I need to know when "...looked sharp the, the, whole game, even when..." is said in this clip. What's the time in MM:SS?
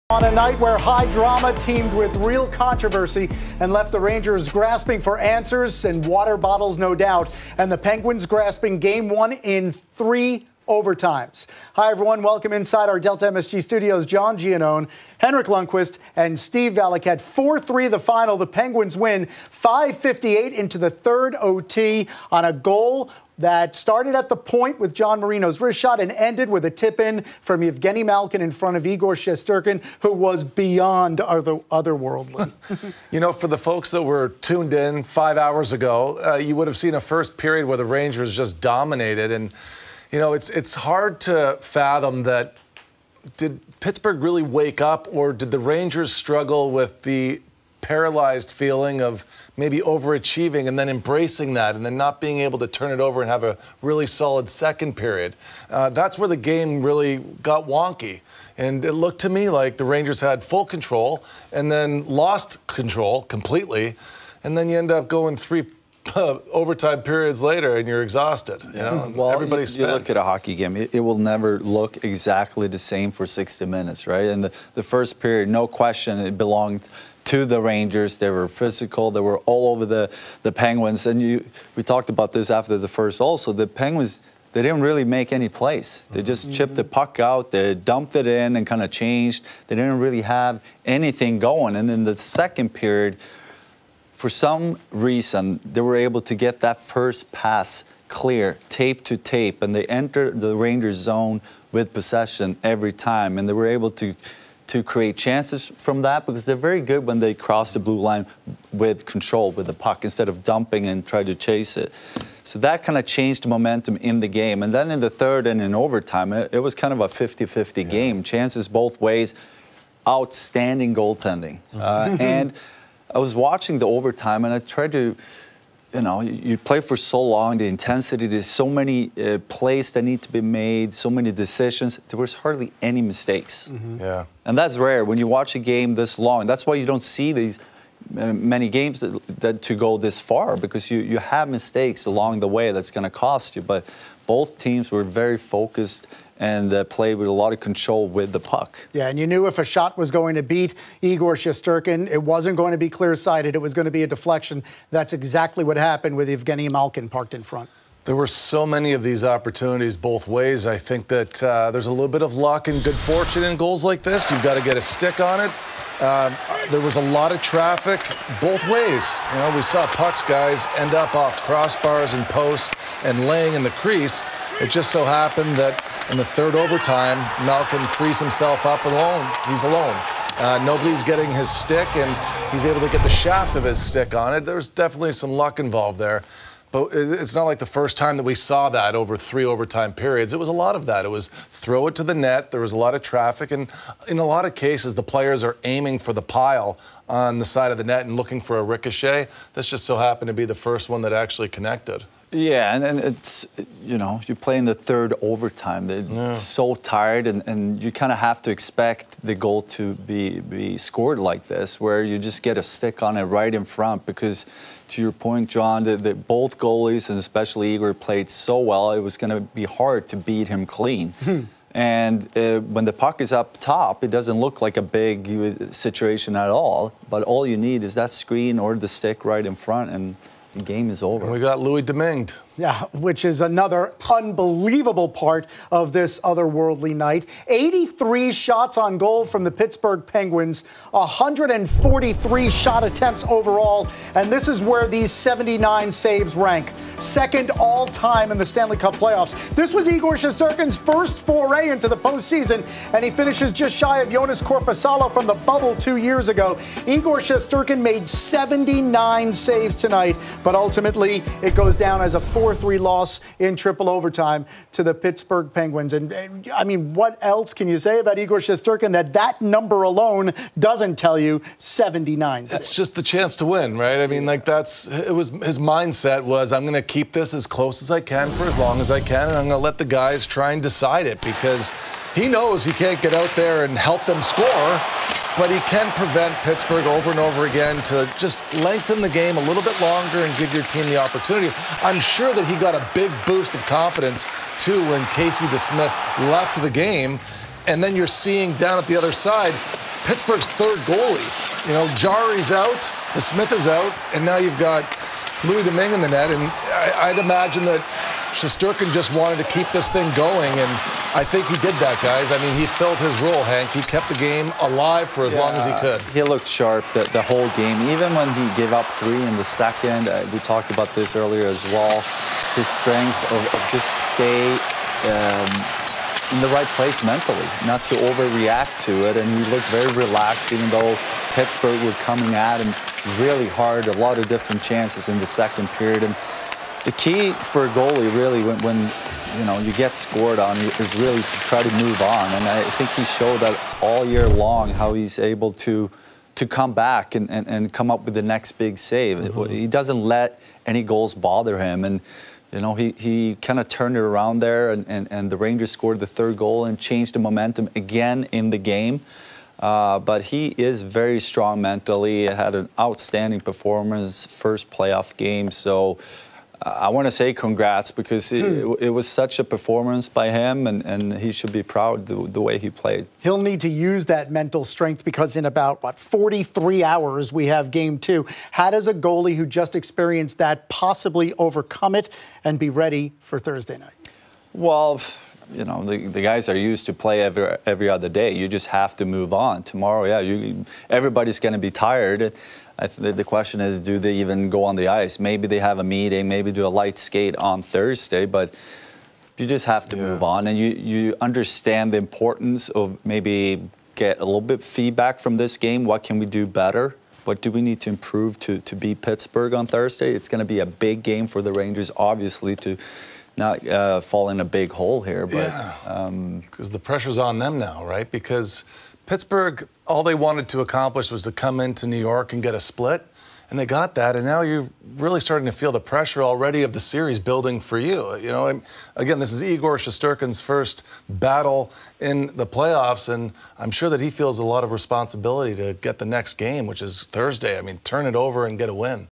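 05:16.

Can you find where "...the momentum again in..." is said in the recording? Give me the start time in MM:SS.
05:57.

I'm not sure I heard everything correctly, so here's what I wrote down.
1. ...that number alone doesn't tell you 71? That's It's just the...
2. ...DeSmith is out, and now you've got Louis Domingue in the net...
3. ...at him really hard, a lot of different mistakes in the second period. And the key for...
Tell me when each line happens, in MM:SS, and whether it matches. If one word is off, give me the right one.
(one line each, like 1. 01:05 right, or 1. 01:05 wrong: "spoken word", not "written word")
1. 04:29 wrong: "79", not "71"
2. 05:03 right
3. 05:32 wrong: "chances", not "mistakes".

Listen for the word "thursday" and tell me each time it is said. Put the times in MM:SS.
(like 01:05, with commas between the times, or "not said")
06:23, 06:37, 06:49, 07:17.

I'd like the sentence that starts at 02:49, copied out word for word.
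You know, we saw pucks guys end up off crossbars and posts and laying in the crease.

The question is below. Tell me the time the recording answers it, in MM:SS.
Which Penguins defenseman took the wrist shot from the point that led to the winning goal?
00:24.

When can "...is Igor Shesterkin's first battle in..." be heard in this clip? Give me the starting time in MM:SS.
07:09.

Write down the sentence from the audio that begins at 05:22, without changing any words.
His strength of, of just stay um, in the right place mentally, not to overreact to it.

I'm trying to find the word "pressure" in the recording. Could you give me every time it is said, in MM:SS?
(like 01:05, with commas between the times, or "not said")
06:56, 07:05.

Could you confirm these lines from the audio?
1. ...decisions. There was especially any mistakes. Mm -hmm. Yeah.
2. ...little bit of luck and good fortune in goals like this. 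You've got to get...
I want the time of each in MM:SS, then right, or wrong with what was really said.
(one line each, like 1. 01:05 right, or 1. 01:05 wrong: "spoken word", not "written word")
1. 02:11 wrong: "hardly", not "especially"
2. 02:41 right.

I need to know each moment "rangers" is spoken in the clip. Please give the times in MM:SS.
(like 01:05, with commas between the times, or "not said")
00:04, 00:37, 00:45, 00:59, 01:17, 01:40, 05:55, 06:51.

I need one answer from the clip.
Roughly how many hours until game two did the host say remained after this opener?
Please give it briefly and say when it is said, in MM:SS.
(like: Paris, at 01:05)
43, at 06:15.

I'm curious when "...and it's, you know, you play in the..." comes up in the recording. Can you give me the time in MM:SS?
03:22.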